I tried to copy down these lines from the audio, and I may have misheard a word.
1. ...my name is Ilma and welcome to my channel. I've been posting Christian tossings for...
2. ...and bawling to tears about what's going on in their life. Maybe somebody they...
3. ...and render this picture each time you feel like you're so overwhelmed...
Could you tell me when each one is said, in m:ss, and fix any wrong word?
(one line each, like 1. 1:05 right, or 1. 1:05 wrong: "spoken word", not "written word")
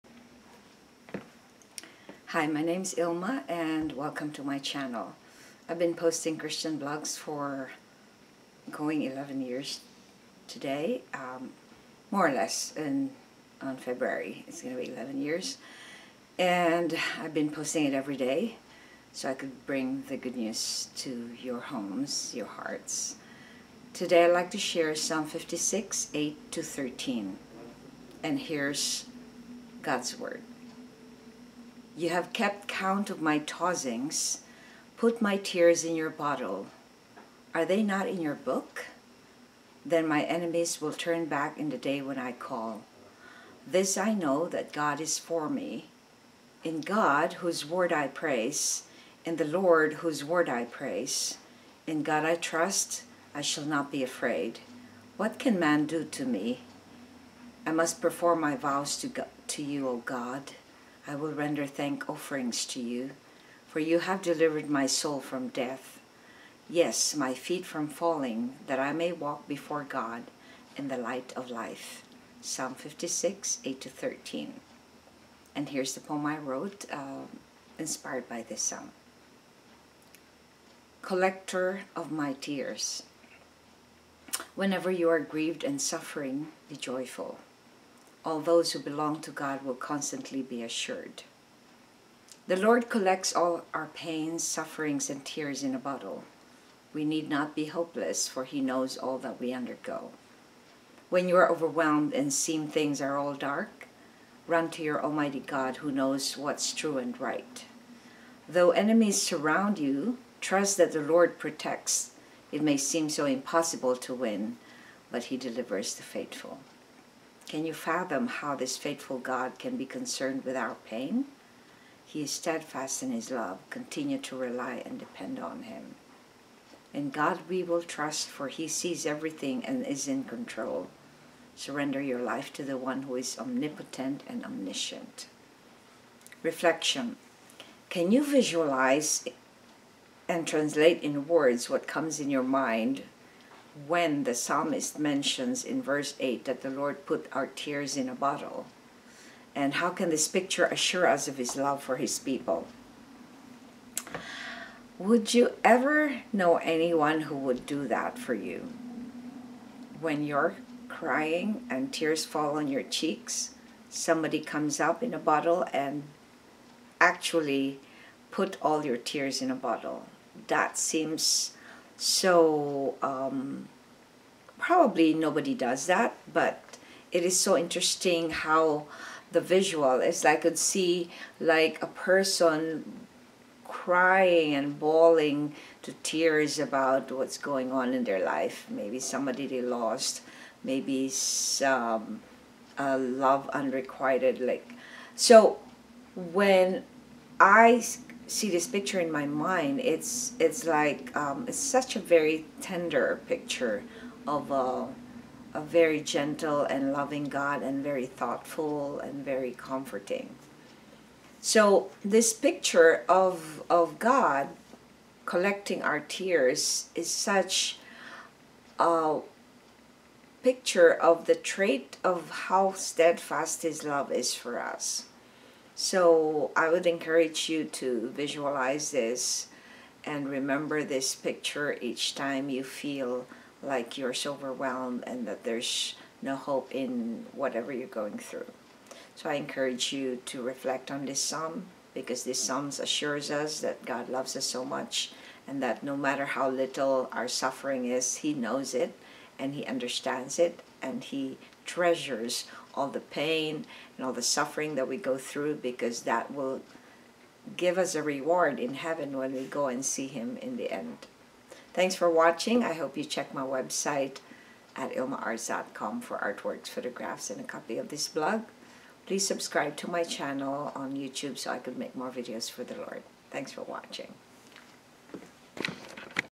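1. 0:02 wrong: "blogs", not "tossings"
2. 3:04 right
3. 3:50 wrong: "remember", not "render".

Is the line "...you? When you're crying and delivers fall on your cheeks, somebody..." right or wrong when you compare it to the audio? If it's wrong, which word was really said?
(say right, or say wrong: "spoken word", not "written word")
wrong: "tears", not "delivers".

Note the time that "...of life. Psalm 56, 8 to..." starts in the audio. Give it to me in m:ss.
1:11.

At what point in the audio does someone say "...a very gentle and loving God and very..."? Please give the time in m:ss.
3:25.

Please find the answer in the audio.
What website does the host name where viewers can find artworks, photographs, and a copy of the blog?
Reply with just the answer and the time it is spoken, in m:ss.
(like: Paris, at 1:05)
ilmaarts.com, at 4:24.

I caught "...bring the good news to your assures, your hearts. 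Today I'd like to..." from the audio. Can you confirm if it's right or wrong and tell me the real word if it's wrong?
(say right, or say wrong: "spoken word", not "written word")
wrong: "homes", not "assures".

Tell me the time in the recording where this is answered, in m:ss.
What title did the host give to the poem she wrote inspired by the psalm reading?
1:21.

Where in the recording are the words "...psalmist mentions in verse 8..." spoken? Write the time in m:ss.
2:24.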